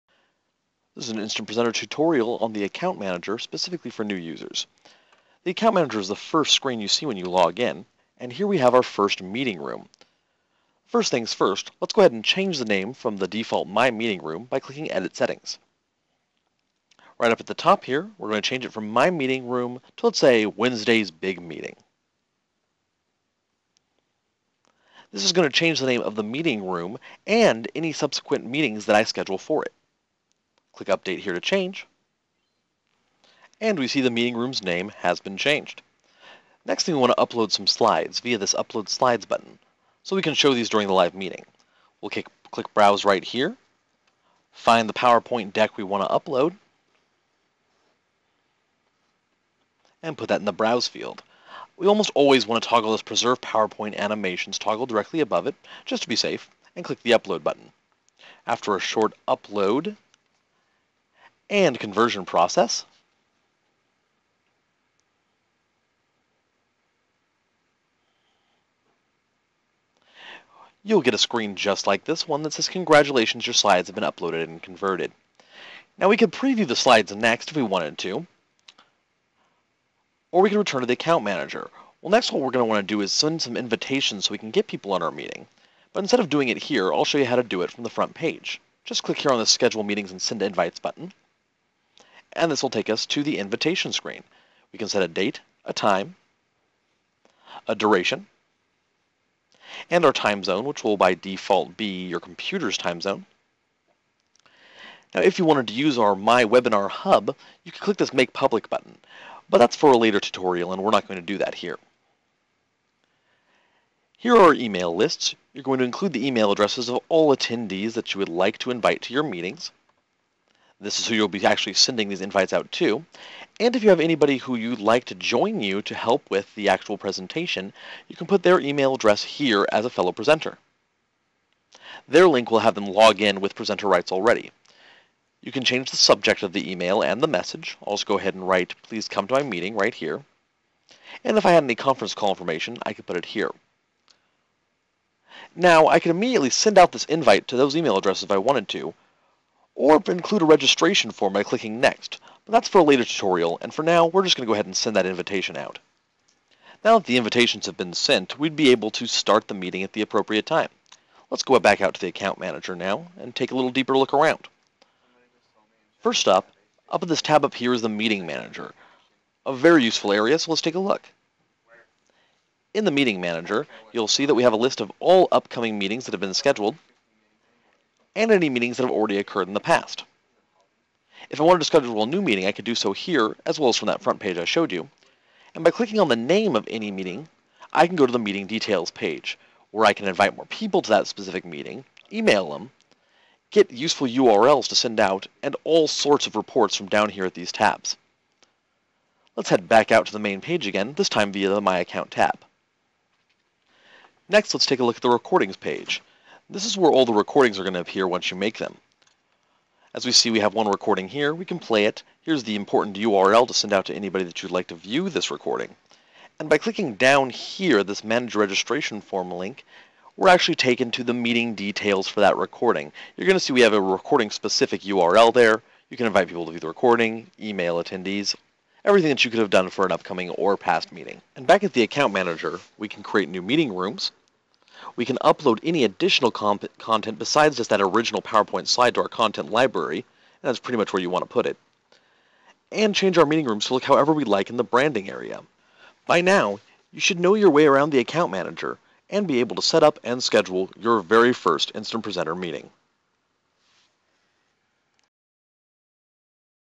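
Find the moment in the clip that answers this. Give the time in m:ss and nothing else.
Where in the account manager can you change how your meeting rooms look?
4:04.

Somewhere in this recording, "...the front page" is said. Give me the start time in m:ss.
1:27.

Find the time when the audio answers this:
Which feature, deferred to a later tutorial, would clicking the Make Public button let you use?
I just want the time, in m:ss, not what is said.
1:46.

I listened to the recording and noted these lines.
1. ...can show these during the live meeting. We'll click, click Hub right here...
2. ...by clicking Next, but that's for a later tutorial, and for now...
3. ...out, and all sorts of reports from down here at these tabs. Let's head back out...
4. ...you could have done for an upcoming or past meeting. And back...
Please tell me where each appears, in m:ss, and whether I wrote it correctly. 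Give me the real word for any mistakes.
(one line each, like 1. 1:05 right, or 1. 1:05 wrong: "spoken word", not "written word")
1. 0:40 wrong: "Browse", not "Hub"
2. 2:31 right
3. 3:14 right
4. 3:49 right.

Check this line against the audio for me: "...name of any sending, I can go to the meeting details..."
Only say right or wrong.
wrong.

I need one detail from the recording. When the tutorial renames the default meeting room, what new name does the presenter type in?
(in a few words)
Wednesday's Big Meeting.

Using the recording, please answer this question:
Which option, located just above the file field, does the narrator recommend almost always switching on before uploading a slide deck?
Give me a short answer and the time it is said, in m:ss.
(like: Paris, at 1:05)
Preserve PowerPoint Animations, at 0:53.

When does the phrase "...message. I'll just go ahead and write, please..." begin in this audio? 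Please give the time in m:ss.
2:17.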